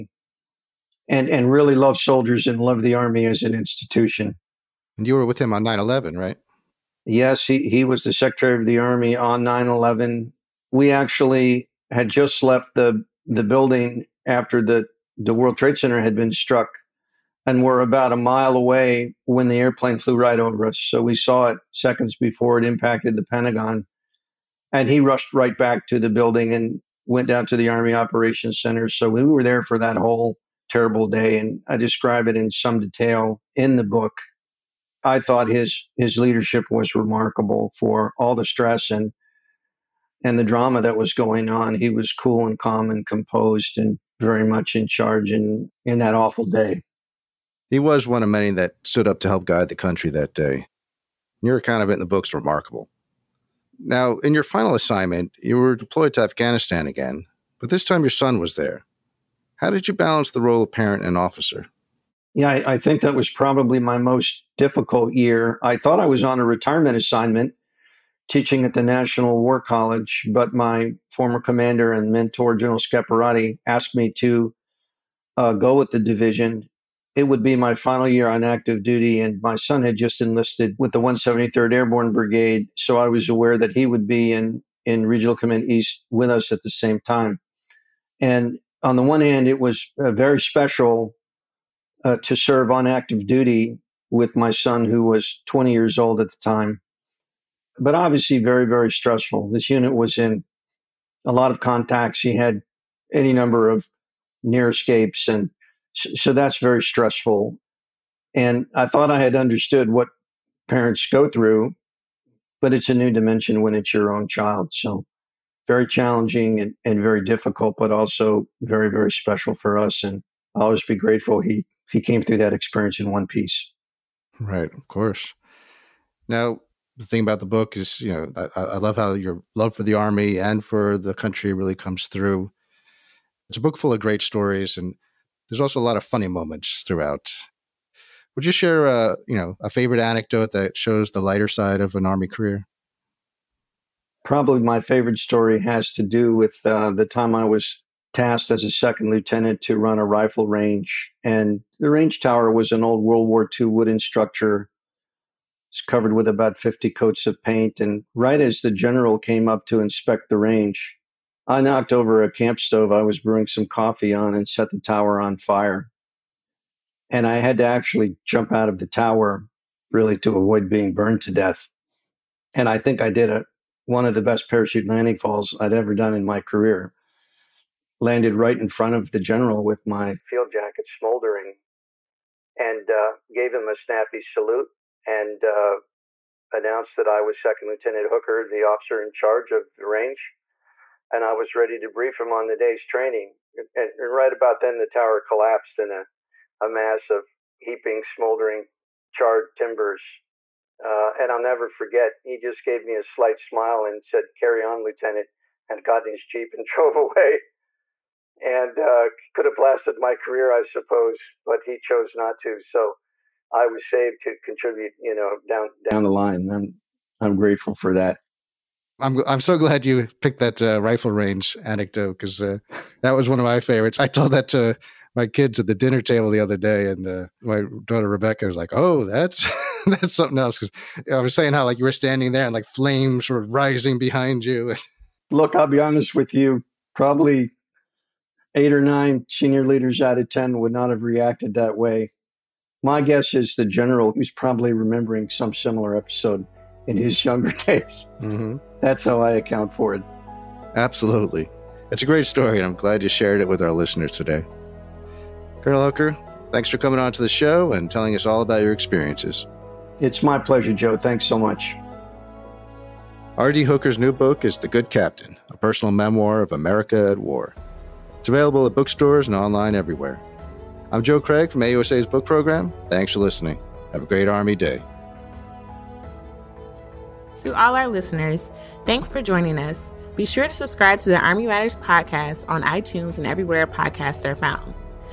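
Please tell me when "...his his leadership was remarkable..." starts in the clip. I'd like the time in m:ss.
0:35.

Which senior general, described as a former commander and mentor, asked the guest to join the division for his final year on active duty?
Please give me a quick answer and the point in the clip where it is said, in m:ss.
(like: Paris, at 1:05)
General Scaparrotti, at 1:12.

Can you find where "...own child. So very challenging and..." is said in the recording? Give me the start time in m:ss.
1:54.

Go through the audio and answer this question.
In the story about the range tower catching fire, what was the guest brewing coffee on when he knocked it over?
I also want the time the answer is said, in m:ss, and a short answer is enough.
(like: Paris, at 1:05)
a camp stove, at 2:42.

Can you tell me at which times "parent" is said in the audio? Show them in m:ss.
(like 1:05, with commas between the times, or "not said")
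1:00, 1:50.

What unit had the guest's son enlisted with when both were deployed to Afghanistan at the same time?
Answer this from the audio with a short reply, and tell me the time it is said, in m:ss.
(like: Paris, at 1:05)
173rd Airborne Brigade, at 1:21.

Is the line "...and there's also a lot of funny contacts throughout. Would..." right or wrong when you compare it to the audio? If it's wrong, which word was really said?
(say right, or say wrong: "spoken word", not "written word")
wrong: "moments", not "contacts".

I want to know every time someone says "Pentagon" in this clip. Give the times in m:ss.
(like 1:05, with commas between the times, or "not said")
0:23.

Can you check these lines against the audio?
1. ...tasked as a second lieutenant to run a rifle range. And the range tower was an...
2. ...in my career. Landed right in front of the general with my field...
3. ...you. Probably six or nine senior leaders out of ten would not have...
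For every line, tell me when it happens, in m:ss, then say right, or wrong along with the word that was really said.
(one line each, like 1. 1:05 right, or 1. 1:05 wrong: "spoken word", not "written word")
1. 2:28 right
2. 2:56 right
3. 3:56 wrong: "eight", not "six".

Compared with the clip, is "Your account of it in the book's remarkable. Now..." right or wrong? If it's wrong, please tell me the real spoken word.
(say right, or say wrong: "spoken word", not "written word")
right.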